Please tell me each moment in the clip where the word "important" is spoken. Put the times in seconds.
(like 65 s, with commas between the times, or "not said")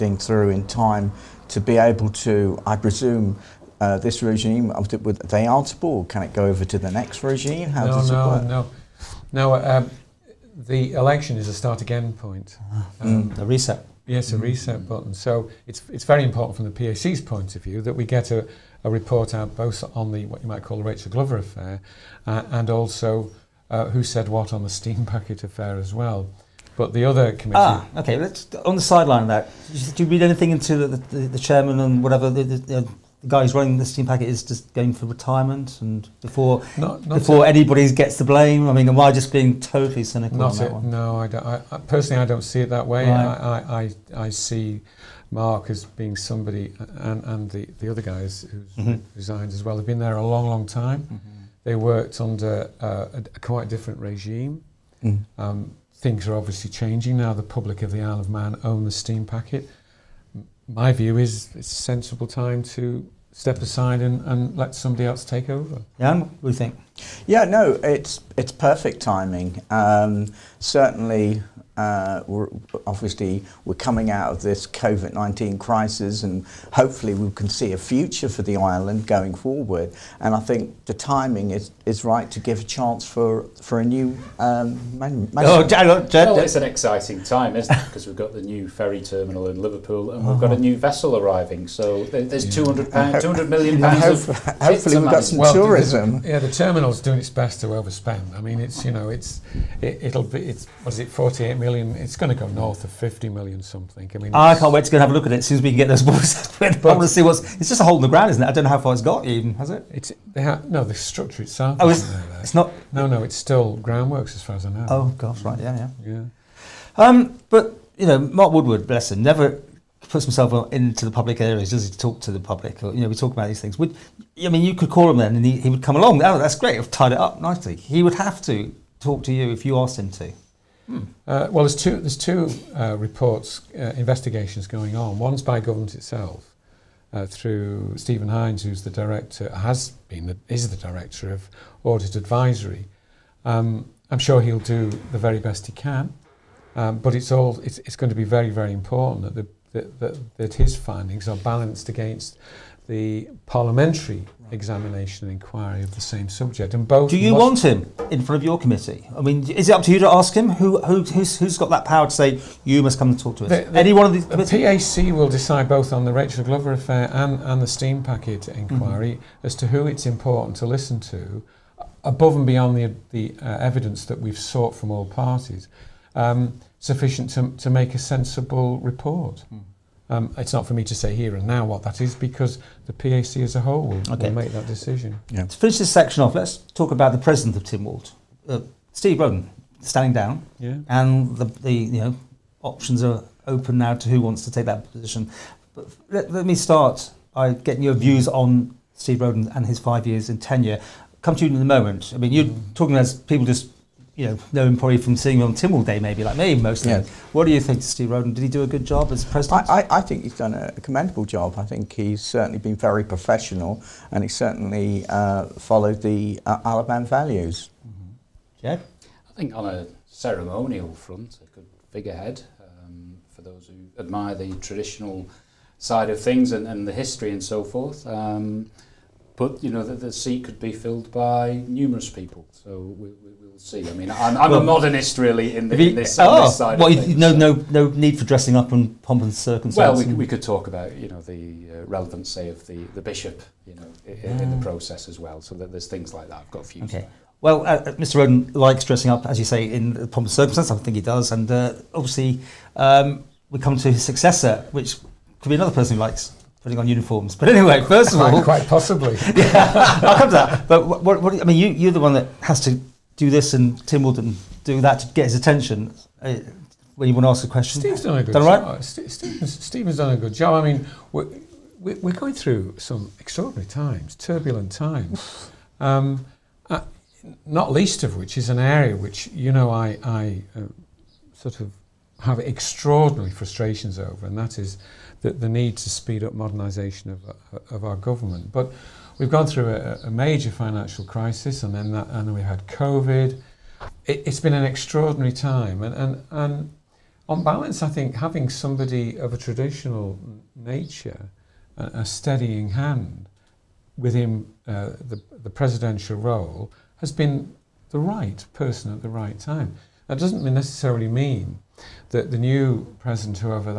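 16 s, 148 s, 170 s.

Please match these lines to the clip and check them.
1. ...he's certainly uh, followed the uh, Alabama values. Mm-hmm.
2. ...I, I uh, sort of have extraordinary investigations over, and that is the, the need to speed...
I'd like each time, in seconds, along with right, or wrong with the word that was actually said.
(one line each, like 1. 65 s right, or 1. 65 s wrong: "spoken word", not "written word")
1. 214 s right
2. 279 s wrong: "frustrations", not "investigations".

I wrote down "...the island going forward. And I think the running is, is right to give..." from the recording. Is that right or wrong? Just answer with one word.
wrong.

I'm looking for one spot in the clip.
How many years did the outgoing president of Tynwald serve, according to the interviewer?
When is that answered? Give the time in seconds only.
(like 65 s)
199 s.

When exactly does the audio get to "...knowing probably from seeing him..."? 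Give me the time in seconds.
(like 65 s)
204 s.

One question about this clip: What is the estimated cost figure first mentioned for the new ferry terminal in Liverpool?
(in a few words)
48 million.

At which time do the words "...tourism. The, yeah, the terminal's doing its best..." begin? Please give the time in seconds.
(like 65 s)
95 s.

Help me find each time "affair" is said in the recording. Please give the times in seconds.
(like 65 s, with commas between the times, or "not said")
21 s, 25 s, 166 s.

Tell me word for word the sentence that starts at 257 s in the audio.
But anyway, first of all, quite possibly.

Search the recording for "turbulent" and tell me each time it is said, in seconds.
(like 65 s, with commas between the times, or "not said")
274 s.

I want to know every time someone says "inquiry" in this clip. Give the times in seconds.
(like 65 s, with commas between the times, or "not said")
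155 s, 168 s.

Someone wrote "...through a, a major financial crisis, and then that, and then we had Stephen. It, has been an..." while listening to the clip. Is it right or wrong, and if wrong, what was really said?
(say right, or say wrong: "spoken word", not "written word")
wrong: "COVID", not "Stephen".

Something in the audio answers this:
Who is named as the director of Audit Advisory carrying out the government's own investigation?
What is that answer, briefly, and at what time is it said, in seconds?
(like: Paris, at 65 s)
Stephen Hines, at 137 s.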